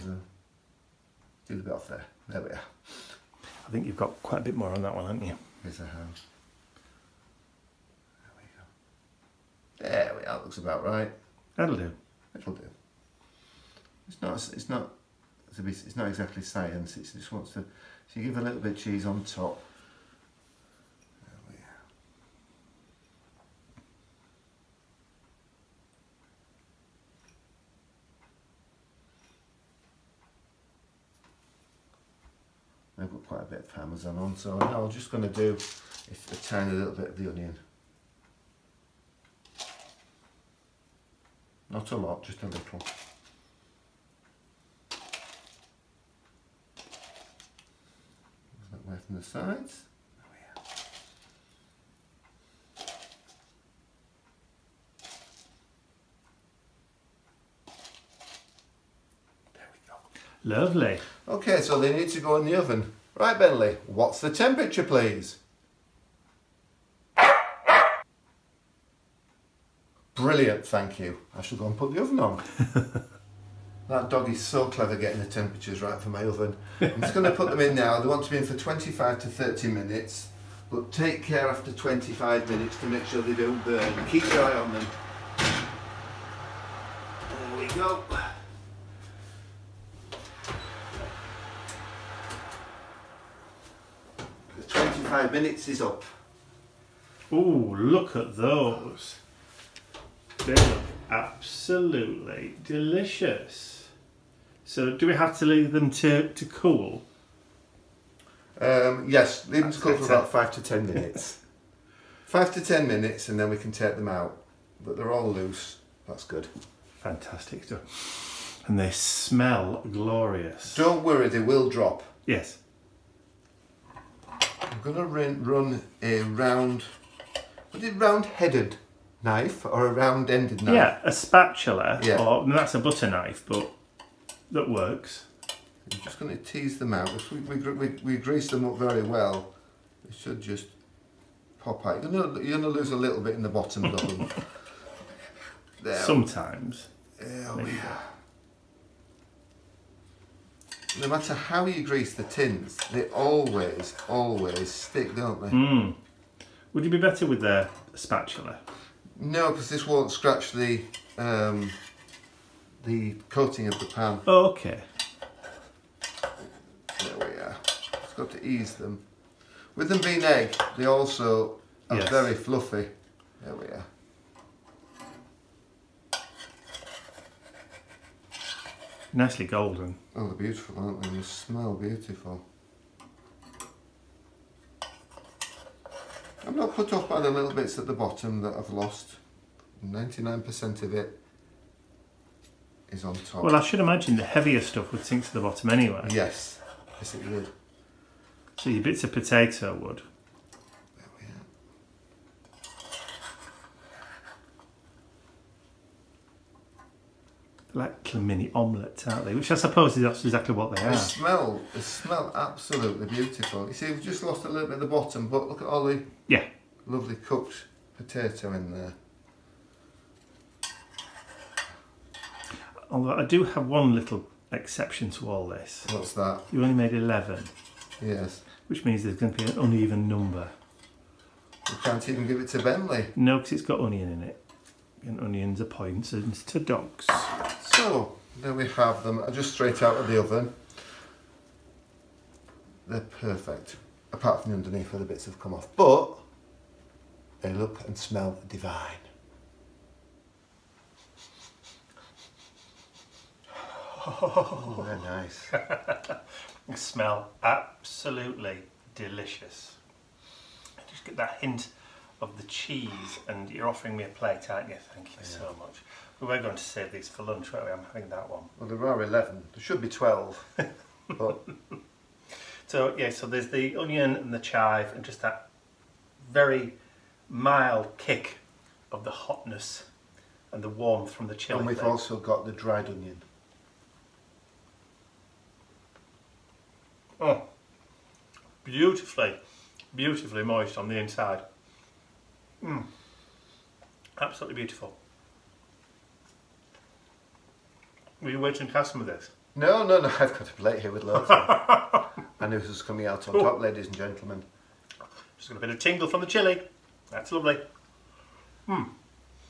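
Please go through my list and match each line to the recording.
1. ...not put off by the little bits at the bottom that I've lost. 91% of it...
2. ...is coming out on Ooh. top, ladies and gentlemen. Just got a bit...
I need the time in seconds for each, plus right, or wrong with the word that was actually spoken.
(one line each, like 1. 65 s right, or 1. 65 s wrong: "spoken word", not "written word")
1. 186 s wrong: "99", not "91"
2. 302 s right.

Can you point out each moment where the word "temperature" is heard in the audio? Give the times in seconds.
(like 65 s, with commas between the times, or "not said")
64 s, 75 s.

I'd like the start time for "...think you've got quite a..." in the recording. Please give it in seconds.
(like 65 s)
3 s.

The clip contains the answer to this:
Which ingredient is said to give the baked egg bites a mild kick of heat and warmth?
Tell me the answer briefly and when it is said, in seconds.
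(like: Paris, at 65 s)
Chili, at 281 s.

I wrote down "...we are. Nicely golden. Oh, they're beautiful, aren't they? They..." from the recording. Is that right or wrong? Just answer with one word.
right.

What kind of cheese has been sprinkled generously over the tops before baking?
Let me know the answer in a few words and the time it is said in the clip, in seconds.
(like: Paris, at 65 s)
Parmesan, at 33 s.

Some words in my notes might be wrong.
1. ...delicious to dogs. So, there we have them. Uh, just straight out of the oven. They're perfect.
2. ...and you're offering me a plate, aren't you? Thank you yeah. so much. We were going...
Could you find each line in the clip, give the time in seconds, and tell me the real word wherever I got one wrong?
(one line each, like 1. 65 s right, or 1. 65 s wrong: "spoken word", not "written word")
1. 235 s wrong: "poisonous", not "delicious"
2. 263 s right.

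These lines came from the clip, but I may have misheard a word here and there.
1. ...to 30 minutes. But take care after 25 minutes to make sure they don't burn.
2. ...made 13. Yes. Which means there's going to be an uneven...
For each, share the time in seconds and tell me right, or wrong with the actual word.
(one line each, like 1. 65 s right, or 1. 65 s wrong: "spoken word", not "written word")
1. 79 s right
2. 226 s wrong: "11", not "13".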